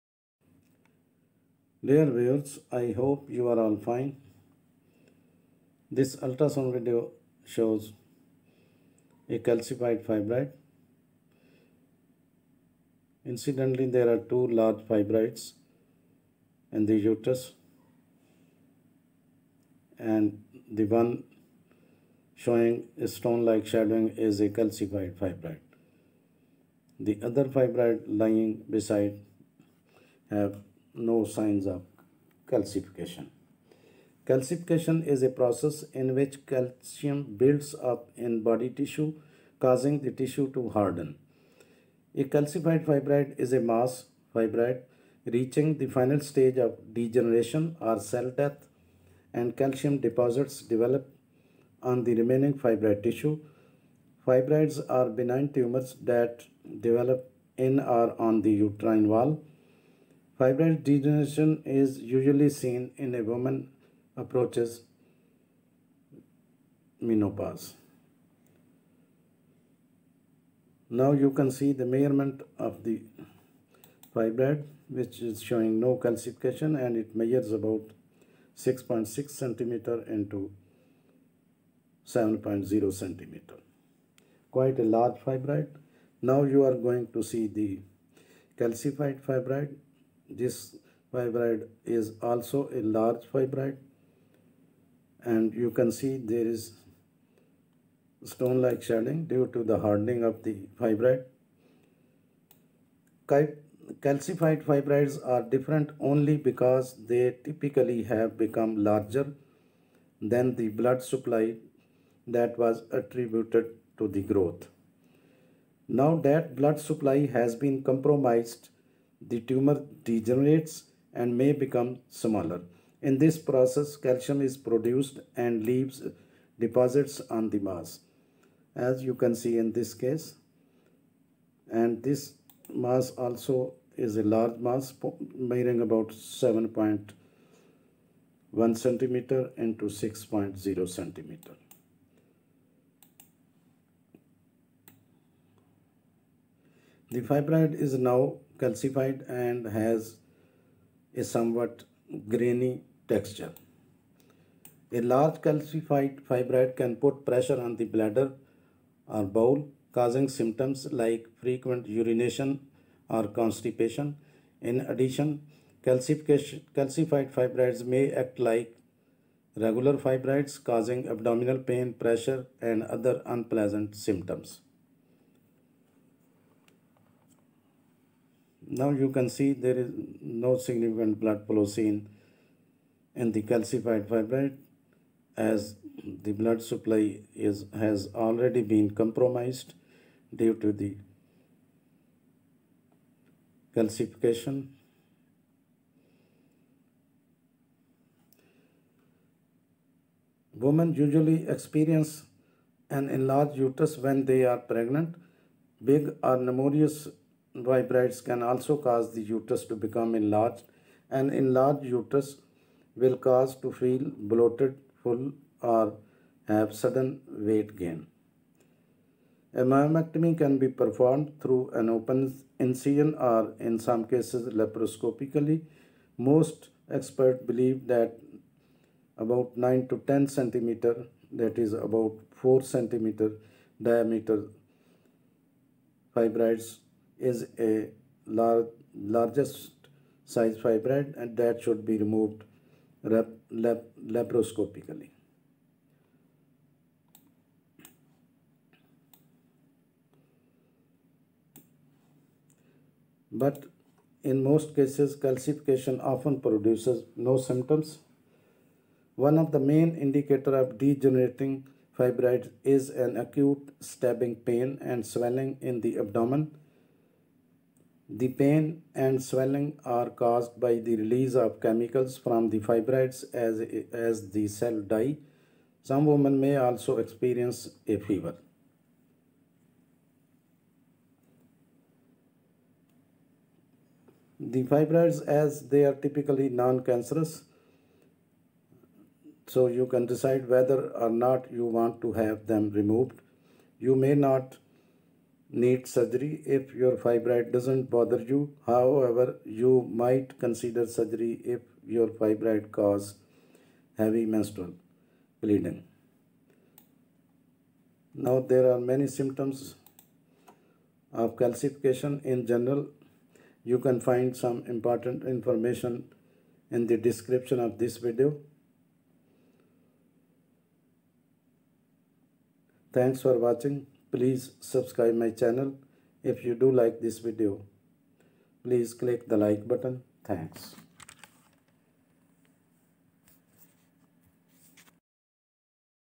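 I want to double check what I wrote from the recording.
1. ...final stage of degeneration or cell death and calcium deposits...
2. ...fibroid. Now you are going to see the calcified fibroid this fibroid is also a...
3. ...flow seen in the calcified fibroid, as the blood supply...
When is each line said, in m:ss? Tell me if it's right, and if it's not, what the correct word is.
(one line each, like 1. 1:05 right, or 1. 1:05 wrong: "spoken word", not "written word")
1. 0:45 right
2. 1:25 right
3. 3:01 right.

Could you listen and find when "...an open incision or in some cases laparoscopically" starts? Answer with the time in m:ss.
3:41.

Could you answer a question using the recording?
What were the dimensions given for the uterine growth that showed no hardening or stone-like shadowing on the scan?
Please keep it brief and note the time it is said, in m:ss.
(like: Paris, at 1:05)
6.6 cm x 7.0 cm, at 1:18.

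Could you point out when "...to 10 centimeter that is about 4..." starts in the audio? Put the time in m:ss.
3:49.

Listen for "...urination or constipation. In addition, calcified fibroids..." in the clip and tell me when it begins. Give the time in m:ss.
2:41.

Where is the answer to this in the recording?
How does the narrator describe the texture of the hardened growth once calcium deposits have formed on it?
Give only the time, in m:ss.
2:32.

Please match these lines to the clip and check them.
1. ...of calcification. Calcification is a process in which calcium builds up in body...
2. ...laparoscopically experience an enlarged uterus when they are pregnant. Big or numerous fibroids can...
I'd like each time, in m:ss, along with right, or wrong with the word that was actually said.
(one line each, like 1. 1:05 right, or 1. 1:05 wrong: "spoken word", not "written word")
1. 0:31 right
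2. 3:21 wrong: "usually", not "laparoscopically".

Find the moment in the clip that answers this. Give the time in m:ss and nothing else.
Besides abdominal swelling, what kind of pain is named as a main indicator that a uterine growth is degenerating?
4:23.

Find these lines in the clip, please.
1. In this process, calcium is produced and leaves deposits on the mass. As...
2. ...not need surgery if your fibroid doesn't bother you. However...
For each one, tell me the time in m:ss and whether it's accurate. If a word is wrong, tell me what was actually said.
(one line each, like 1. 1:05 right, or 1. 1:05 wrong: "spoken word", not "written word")
1. 2:03 right
2. 4:54 right.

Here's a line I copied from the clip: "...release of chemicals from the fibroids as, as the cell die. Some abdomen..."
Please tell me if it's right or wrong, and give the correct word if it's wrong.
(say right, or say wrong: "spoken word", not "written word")
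wrong: "women", not "abdomen".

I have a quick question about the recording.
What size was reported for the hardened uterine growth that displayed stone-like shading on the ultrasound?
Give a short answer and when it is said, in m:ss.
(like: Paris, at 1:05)
7.1 cm x 6.0 cm, at 2:16.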